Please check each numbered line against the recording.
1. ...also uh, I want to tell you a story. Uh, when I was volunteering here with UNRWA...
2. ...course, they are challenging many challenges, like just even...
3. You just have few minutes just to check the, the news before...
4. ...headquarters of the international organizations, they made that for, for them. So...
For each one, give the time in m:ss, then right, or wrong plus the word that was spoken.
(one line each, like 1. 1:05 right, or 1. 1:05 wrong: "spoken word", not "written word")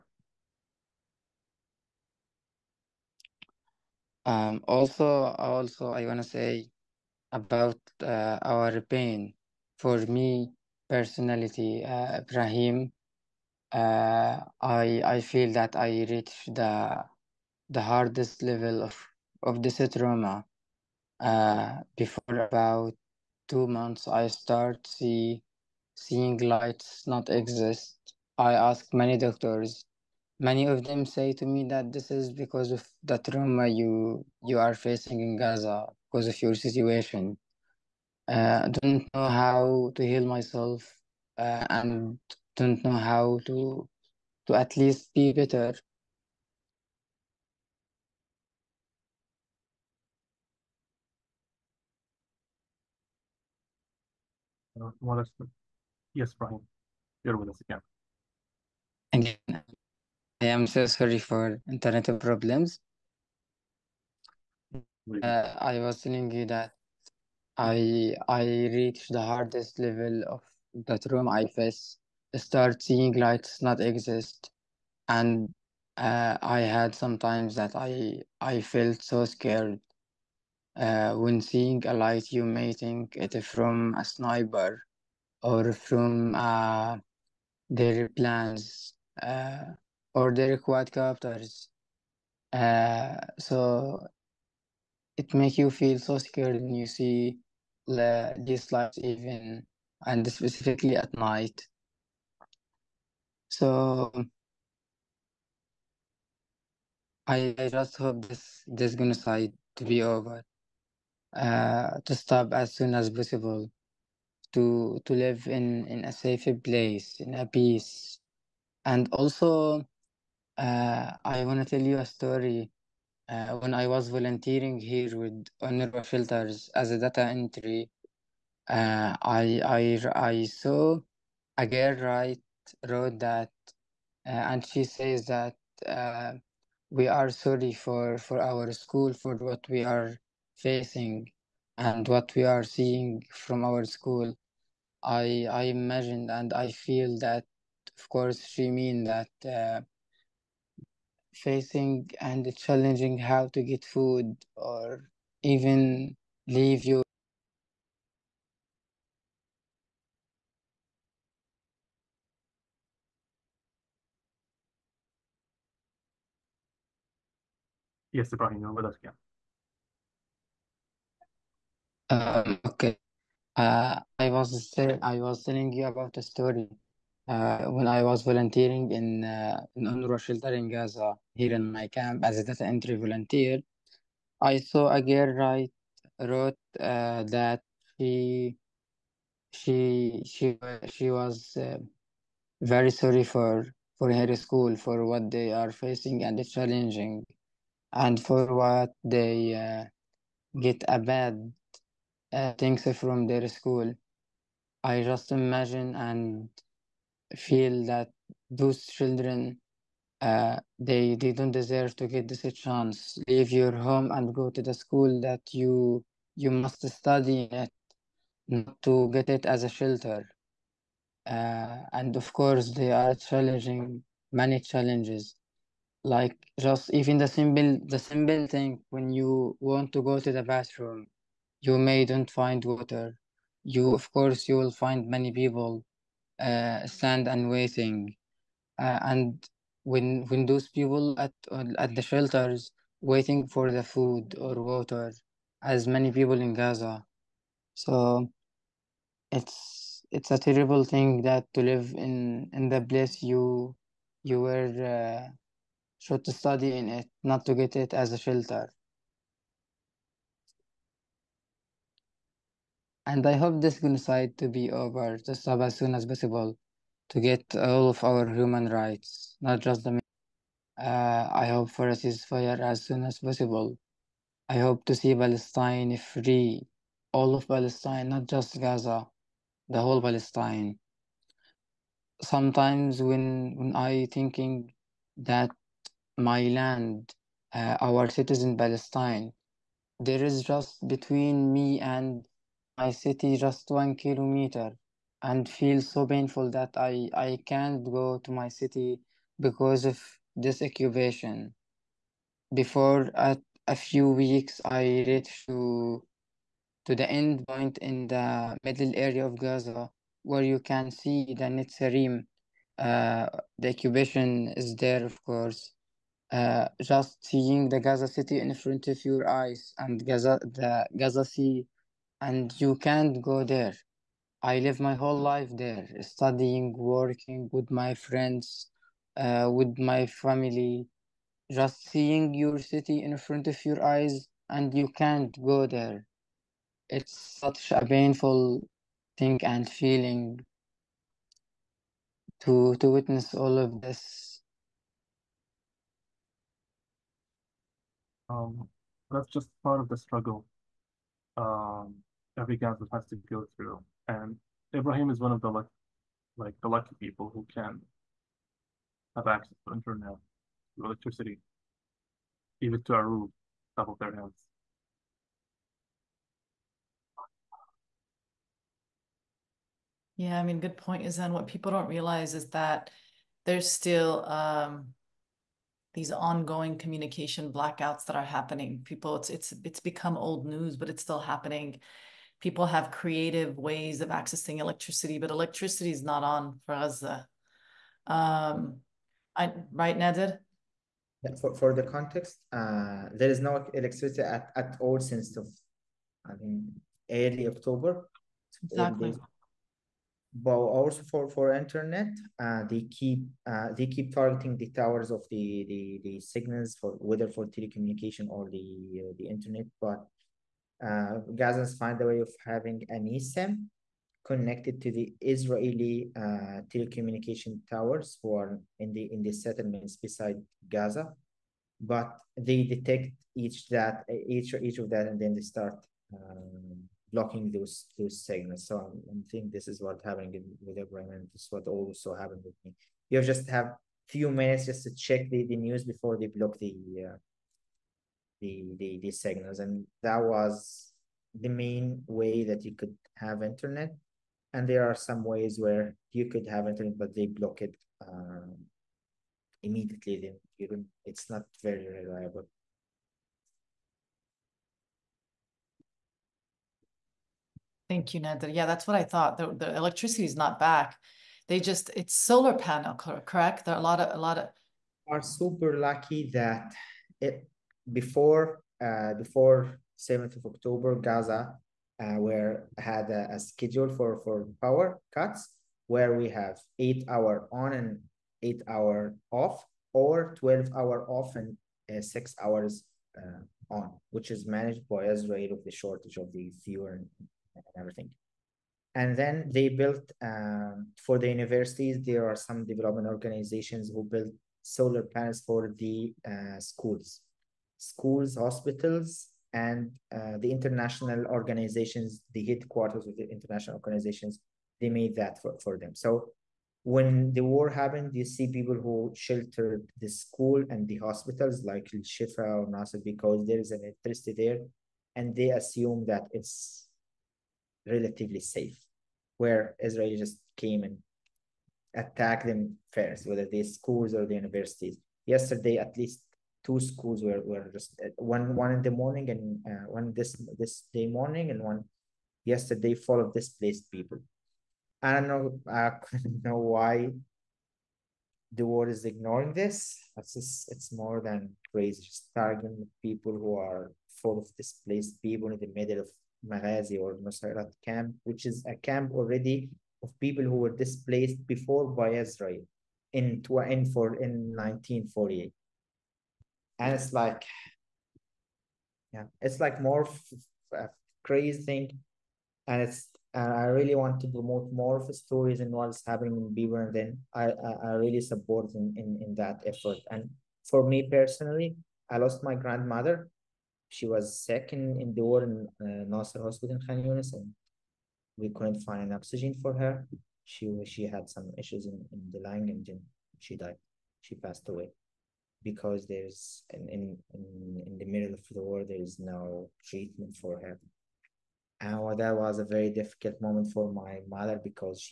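1. 1:59 right
2. 3:42 right
3. 7:13 right
4. 8:22 right.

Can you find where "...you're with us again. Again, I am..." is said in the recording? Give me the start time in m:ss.
0:57.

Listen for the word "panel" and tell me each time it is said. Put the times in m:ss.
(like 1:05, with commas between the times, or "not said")
7:42, 8:15.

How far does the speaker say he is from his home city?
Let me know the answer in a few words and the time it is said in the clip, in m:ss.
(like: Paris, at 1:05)
1 kilometer, at 4:53.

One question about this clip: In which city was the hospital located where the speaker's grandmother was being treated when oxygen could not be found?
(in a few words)
Khan Yunis.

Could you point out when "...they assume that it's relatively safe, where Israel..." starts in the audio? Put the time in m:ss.
8:35.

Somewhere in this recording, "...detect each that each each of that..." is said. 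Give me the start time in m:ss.
7:02.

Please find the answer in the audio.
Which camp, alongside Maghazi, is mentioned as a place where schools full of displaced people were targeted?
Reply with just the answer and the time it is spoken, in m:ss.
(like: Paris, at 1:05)
Nusayrat, at 9:07.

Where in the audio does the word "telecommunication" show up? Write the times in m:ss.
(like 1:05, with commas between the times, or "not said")
6:47, 6:56.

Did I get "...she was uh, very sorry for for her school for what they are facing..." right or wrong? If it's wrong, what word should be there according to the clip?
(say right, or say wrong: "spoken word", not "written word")
right.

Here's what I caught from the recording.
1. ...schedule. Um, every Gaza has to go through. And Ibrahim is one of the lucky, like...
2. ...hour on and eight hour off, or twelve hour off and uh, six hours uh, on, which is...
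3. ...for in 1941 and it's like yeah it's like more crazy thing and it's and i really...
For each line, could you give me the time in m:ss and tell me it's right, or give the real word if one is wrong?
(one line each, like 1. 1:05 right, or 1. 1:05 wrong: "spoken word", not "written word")
1. 5:49 wrong: "struggle", not "schedule"
2. 7:57 right
3. 9:13 wrong: "1948", not "1941".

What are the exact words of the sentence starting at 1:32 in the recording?
Uh, so it makes you feel so scared when you see the, these lights even and specifically at night.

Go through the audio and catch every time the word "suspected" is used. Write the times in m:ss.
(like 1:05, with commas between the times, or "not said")
not said.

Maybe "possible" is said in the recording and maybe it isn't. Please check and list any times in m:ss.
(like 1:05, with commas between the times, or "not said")
1:53, 4:26, 4:33.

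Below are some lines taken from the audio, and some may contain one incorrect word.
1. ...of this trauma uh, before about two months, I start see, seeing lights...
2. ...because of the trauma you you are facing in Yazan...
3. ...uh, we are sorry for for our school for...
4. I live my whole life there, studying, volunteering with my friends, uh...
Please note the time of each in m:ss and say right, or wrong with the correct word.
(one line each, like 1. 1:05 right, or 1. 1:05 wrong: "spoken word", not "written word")
1. 0:19 right
2. 0:32 wrong: "Gaza", not "Yazan"
3. 2:15 right
4. 5:24 wrong: "working", not "volunteering".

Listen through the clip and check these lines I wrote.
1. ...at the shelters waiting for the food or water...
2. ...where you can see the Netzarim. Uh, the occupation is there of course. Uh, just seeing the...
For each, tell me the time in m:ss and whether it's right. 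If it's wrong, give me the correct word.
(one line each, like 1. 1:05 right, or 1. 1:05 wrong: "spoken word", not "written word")
1. 4:01 right
2. 5:10 right.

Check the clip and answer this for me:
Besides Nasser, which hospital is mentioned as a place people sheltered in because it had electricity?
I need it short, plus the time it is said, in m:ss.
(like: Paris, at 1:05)
Shifa, at 8:31.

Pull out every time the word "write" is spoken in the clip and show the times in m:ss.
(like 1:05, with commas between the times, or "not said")
2:12, 3:05.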